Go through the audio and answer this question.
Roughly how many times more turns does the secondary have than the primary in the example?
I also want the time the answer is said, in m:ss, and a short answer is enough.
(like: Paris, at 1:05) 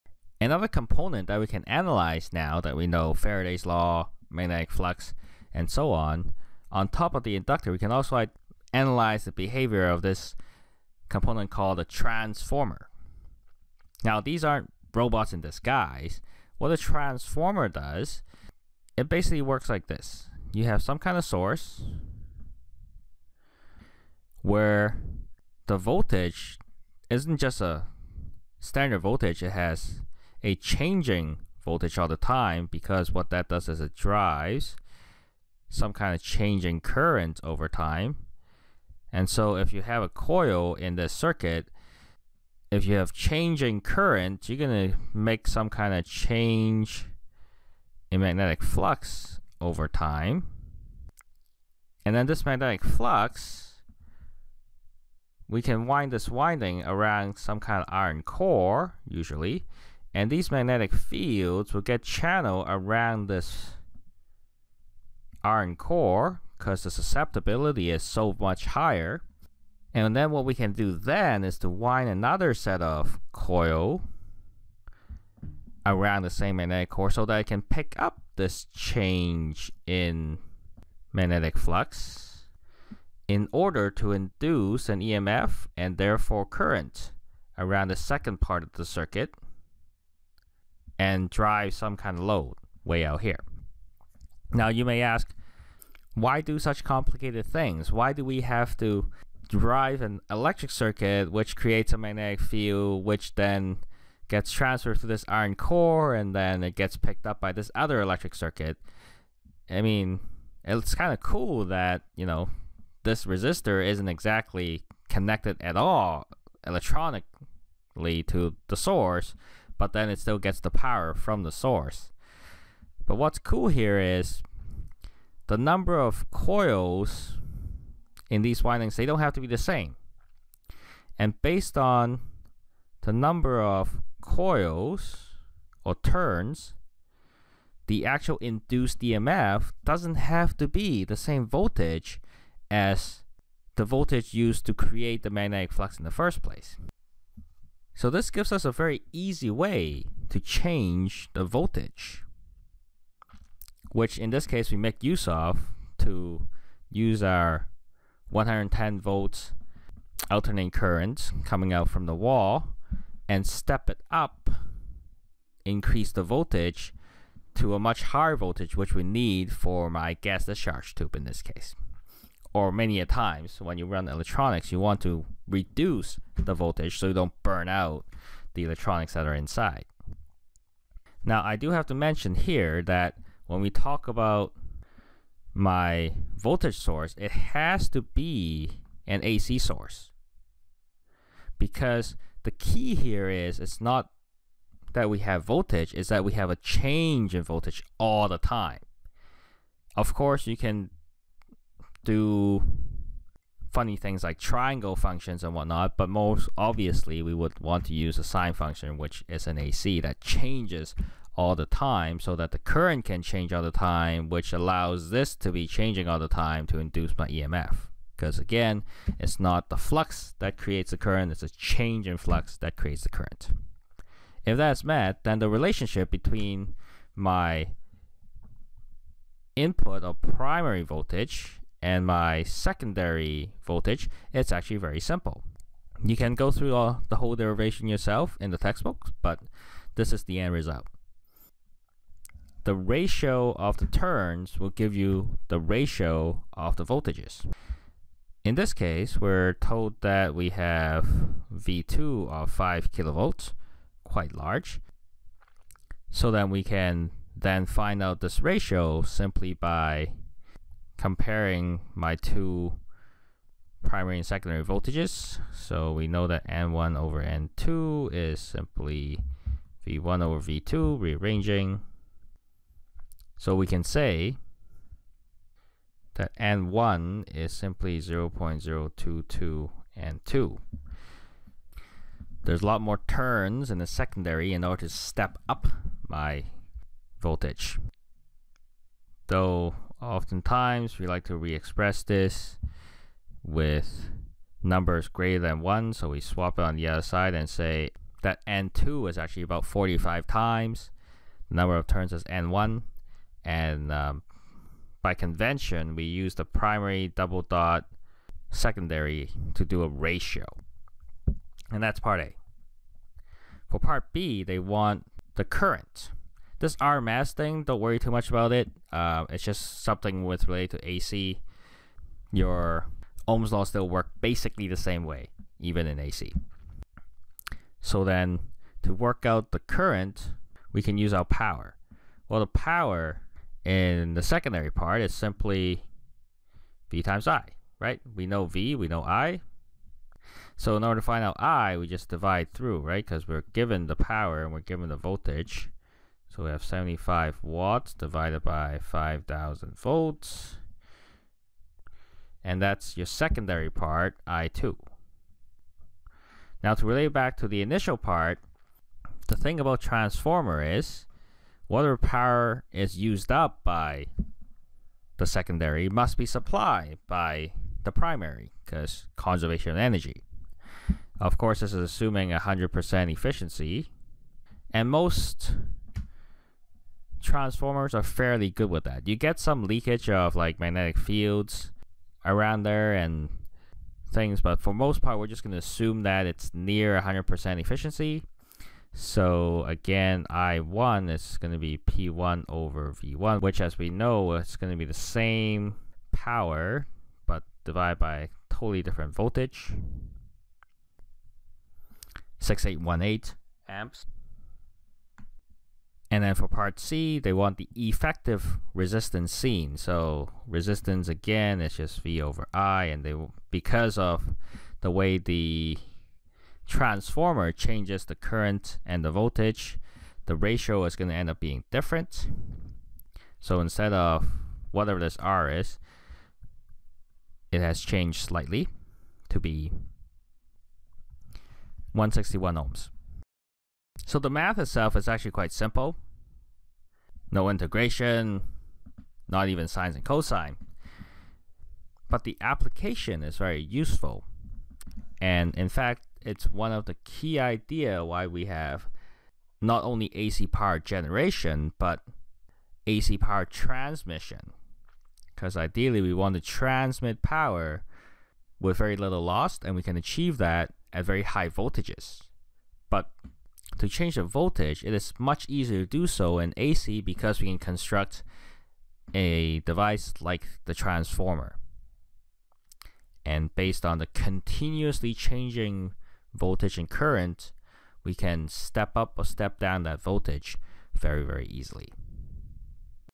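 45, at 4:59.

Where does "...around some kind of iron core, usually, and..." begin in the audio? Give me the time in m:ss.
0:56.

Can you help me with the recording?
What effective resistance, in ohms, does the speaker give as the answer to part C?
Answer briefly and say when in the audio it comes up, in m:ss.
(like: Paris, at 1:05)
161 ohms, at 7:11.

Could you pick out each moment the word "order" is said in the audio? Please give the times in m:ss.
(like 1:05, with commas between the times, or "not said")
1:23, 4:44, 5:40.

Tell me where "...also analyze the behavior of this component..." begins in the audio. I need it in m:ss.
0:07.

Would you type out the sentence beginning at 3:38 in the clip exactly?
Because again, it's not the flux that creates the current, it's a change in flux that creates the current.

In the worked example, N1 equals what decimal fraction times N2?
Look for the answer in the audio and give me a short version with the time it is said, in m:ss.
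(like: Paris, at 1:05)
0.022, at 4:37.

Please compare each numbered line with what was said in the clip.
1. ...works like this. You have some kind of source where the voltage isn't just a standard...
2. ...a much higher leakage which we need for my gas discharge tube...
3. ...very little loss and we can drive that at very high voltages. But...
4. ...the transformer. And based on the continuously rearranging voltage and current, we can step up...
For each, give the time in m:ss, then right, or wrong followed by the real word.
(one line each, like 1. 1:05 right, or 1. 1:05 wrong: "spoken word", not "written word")
1. 0:19 right
2. 2:47 wrong: "voltage", not "leakage"
3. 7:38 wrong: "achieve", not "drive"
4. 7:50 wrong: "changing", not "rearranging".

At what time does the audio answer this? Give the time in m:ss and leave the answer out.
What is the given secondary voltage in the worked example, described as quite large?
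4:12.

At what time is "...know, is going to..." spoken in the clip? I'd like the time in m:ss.
6:33.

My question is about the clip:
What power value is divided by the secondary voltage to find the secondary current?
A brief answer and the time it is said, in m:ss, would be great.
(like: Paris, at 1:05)
75 watts, at 5:46.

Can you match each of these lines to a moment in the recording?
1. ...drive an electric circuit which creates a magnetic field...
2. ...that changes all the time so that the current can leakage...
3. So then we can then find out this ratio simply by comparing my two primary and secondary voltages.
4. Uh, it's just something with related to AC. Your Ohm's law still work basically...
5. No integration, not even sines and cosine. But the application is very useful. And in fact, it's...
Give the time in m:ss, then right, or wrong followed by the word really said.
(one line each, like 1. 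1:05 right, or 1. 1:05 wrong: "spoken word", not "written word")
1. 1:39 right
2. 3:30 wrong: "change", not "leakage"
3. 4:16 right
4. 5:18 right
5. 7:17 right.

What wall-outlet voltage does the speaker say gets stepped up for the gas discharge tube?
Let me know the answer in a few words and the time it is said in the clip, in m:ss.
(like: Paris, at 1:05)
110 volts, at 2:38.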